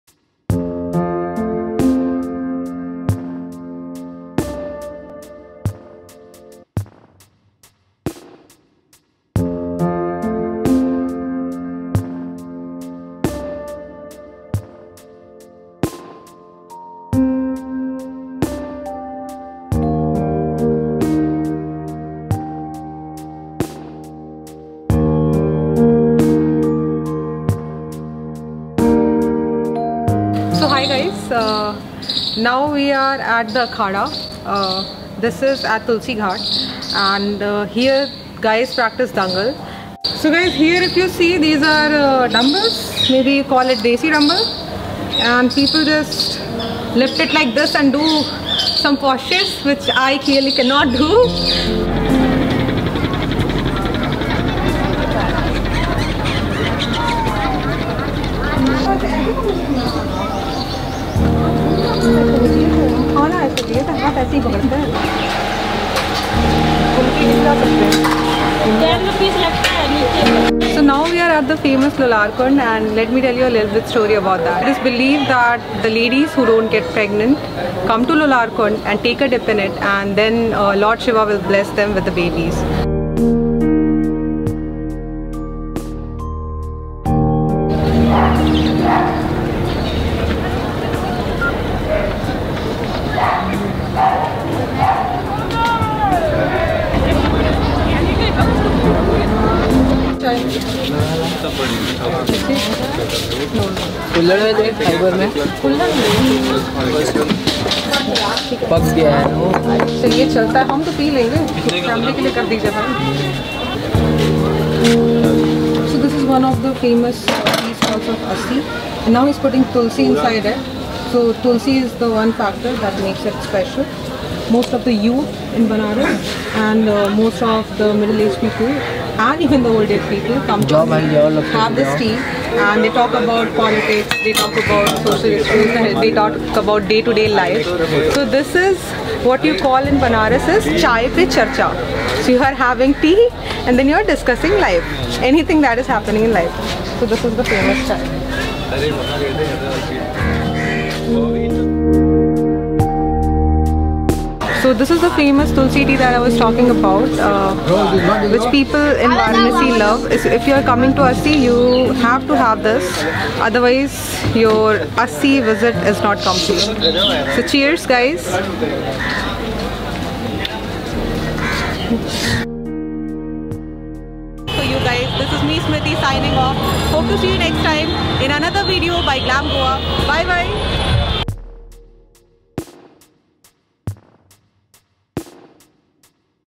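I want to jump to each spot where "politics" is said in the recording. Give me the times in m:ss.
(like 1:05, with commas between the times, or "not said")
2:13.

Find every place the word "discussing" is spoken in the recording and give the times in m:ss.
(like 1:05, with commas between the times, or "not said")
2:24.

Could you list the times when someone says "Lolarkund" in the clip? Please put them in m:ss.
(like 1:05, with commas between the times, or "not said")
1:11, 1:18.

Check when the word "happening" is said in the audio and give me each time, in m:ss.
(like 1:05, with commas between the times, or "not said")
2:25.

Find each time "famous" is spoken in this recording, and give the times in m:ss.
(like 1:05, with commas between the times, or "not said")
1:11, 2:27, 2:35.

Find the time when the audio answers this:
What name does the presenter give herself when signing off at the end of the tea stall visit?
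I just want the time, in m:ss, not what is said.
2:55.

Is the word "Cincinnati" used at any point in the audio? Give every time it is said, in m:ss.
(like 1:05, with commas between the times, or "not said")
not said.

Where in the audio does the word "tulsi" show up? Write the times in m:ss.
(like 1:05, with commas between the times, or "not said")
0:35, 2:35.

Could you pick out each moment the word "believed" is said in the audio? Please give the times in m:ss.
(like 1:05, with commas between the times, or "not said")
1:14.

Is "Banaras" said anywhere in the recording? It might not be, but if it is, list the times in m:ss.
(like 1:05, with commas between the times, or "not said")
2:20.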